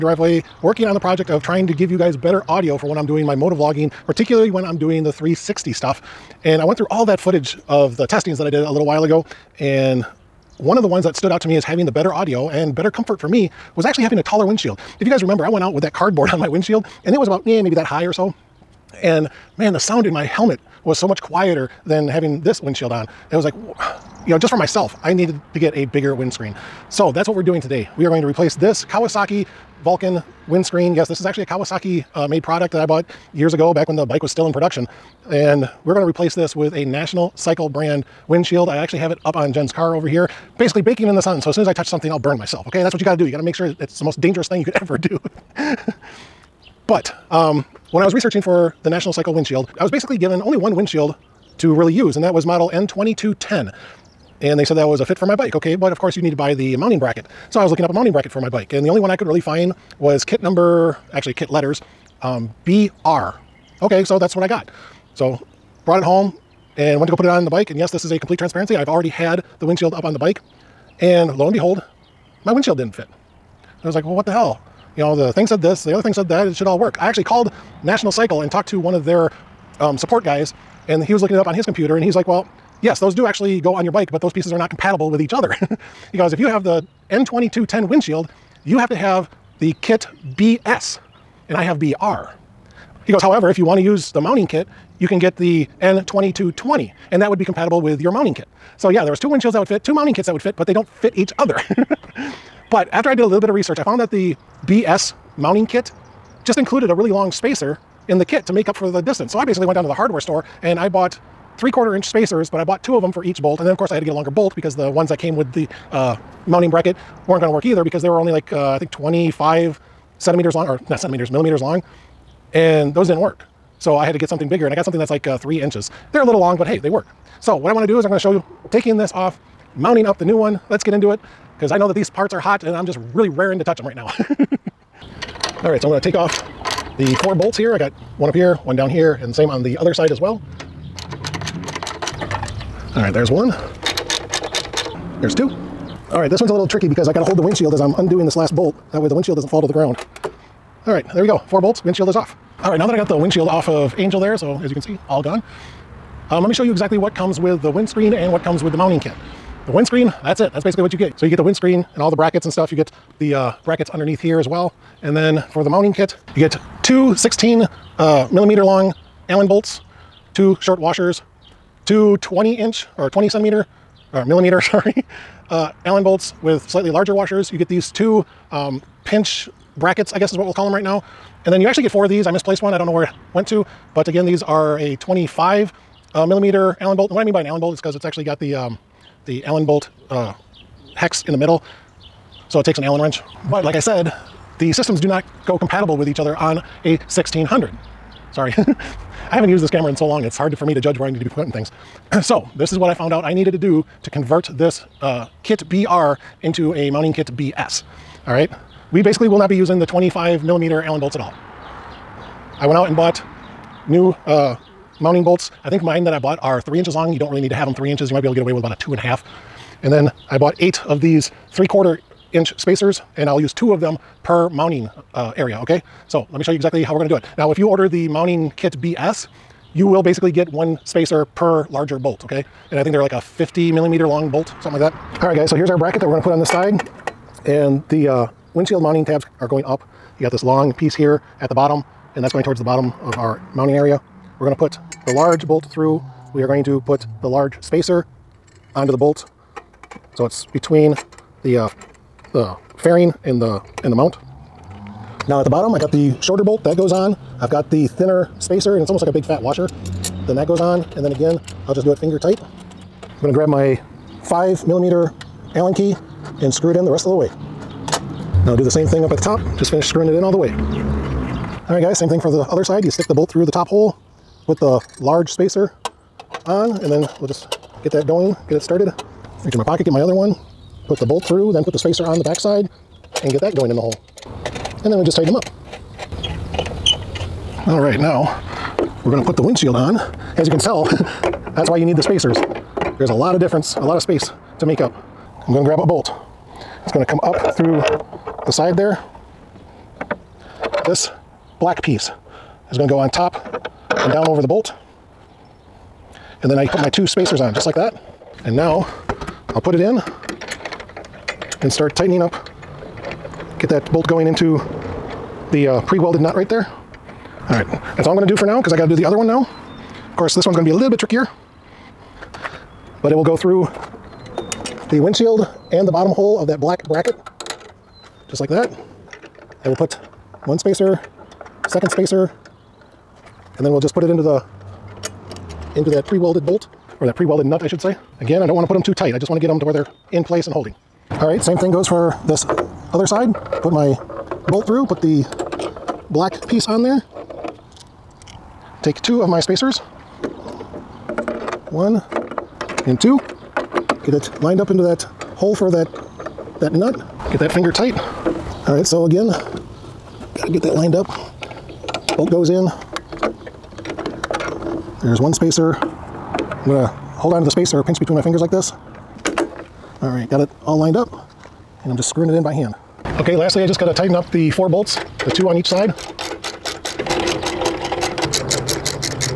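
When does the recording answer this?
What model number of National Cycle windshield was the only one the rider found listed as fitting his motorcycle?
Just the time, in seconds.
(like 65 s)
52 s.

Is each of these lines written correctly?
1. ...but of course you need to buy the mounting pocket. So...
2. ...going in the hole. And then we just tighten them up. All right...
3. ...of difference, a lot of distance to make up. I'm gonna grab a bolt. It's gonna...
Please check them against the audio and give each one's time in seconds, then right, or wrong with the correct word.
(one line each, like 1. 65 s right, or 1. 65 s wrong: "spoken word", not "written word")
1. 55 s wrong: "bracket", not "pocket"
2. 283 s right
3. 293 s wrong: "space", not "distance".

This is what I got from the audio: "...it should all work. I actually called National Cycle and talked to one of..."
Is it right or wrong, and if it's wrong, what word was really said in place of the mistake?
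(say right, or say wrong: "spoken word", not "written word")
right.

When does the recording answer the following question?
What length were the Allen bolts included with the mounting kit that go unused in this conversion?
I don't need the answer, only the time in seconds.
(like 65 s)
209 s.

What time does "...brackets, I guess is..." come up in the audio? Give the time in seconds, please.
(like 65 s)
179 s.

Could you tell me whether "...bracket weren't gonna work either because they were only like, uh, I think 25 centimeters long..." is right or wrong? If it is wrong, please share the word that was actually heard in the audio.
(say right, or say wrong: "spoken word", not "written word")
right.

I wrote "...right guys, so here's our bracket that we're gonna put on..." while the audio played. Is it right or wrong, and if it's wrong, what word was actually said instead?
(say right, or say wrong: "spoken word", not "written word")
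right.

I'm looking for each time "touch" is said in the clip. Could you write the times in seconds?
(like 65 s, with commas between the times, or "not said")
41 s, 133 s.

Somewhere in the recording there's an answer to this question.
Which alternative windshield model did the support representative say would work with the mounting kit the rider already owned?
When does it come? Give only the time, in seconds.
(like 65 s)
95 s.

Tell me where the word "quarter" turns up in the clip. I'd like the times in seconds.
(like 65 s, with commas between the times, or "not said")
111 s, 221 s.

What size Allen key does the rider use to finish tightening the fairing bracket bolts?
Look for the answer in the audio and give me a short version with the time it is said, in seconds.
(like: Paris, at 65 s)
5 millimeter, at 264 s.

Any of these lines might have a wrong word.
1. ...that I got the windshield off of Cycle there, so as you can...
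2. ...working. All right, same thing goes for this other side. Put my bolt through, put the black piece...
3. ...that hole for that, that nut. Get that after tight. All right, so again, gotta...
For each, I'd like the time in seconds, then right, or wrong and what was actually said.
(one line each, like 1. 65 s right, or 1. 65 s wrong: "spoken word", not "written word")
1. 152 s wrong: "Angel", not "Cycle"
2. 340 s wrong: "holding", not "working"
3. 354 s wrong: "finger", not "after".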